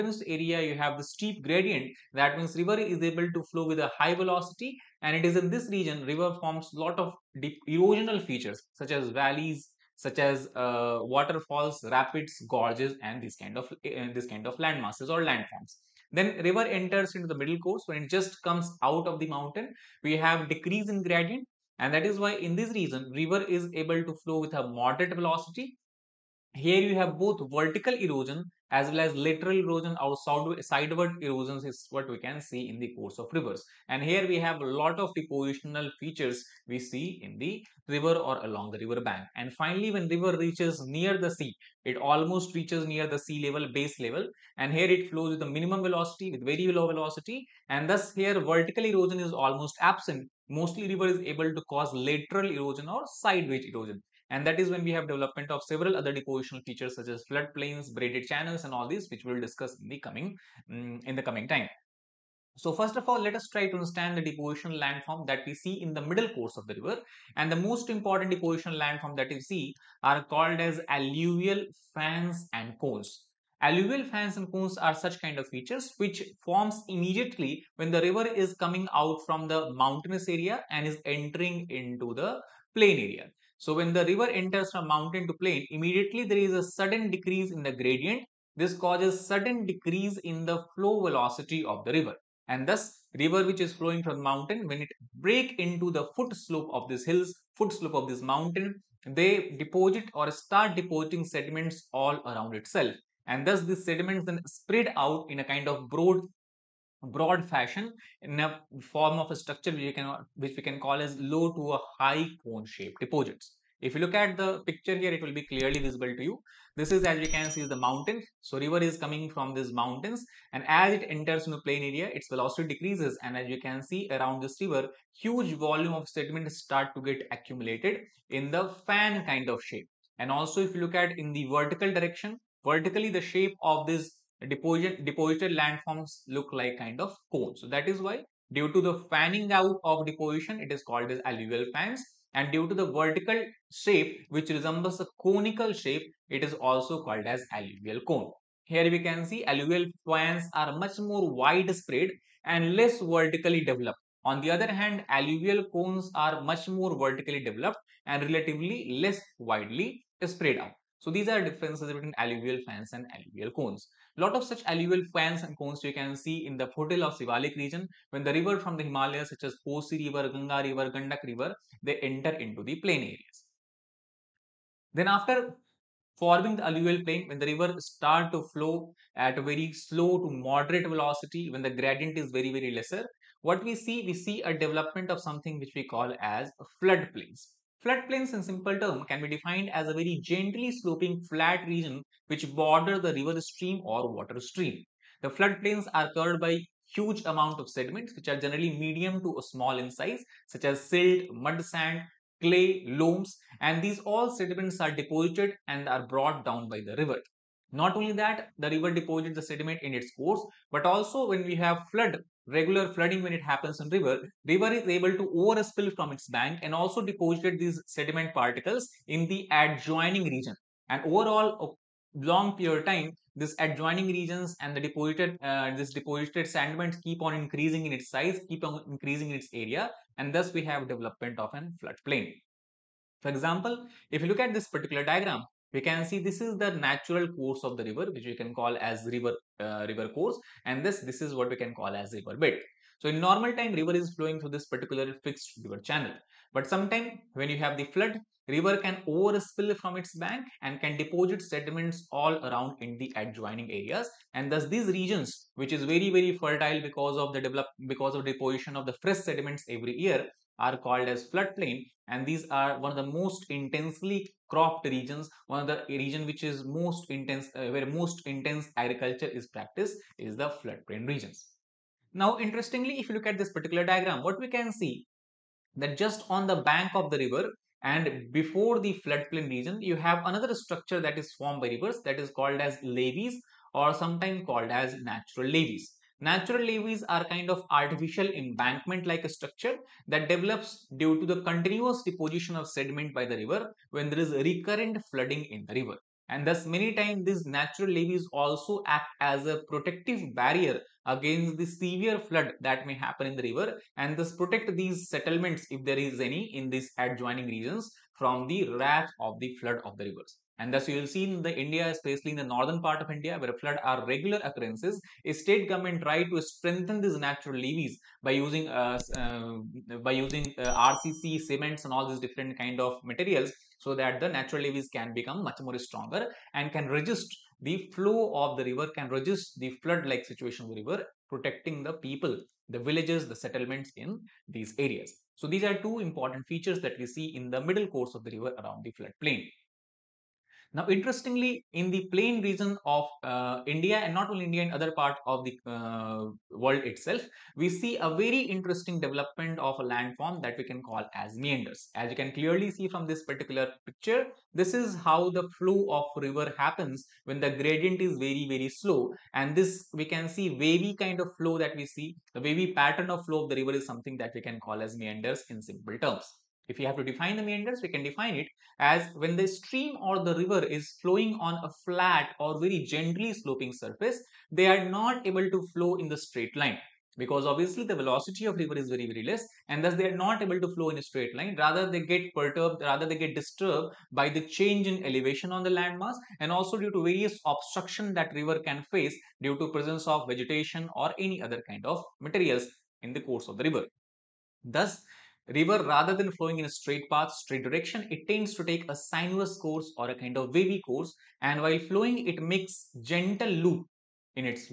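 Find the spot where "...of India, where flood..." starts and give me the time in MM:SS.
05:13.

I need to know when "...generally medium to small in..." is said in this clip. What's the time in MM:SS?
03:18.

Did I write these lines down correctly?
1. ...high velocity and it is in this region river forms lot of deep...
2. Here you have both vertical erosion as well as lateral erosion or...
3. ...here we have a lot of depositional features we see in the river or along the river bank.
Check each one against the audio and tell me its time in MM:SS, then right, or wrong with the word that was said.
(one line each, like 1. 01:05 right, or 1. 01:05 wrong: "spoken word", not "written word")
1. 00:03 right
2. 00:26 right
3. 00:34 right.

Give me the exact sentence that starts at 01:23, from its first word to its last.
So when the river enters from mountain to plain, immediately there is a sudden decrease in the gradient.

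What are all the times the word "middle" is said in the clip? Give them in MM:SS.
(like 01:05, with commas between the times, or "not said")
00:17, 01:06, 05:37.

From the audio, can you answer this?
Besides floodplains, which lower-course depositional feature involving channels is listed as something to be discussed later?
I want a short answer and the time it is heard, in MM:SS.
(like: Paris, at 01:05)
Braided channels, at 00:57.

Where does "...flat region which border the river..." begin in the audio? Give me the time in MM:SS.
03:11.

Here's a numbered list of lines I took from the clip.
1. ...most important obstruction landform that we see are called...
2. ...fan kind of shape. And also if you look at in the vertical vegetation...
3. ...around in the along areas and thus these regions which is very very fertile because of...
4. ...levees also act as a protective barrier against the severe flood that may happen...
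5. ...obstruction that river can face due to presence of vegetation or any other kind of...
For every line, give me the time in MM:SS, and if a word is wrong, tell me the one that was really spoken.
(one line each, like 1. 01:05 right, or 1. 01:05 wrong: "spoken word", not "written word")
1. 01:07 wrong: "deposition", not "obstruction"
2. 02:08 wrong: "direction", not "vegetation"
3. 04:12 wrong: "adjoining", not "along"
4. 04:57 right
5. 06:27 right.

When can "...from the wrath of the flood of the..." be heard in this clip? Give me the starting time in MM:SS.
05:08.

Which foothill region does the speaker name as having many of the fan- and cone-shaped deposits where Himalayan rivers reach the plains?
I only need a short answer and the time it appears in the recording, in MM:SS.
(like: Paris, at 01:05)
Sivalik, at 02:47.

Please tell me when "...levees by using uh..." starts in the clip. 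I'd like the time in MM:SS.
05:17.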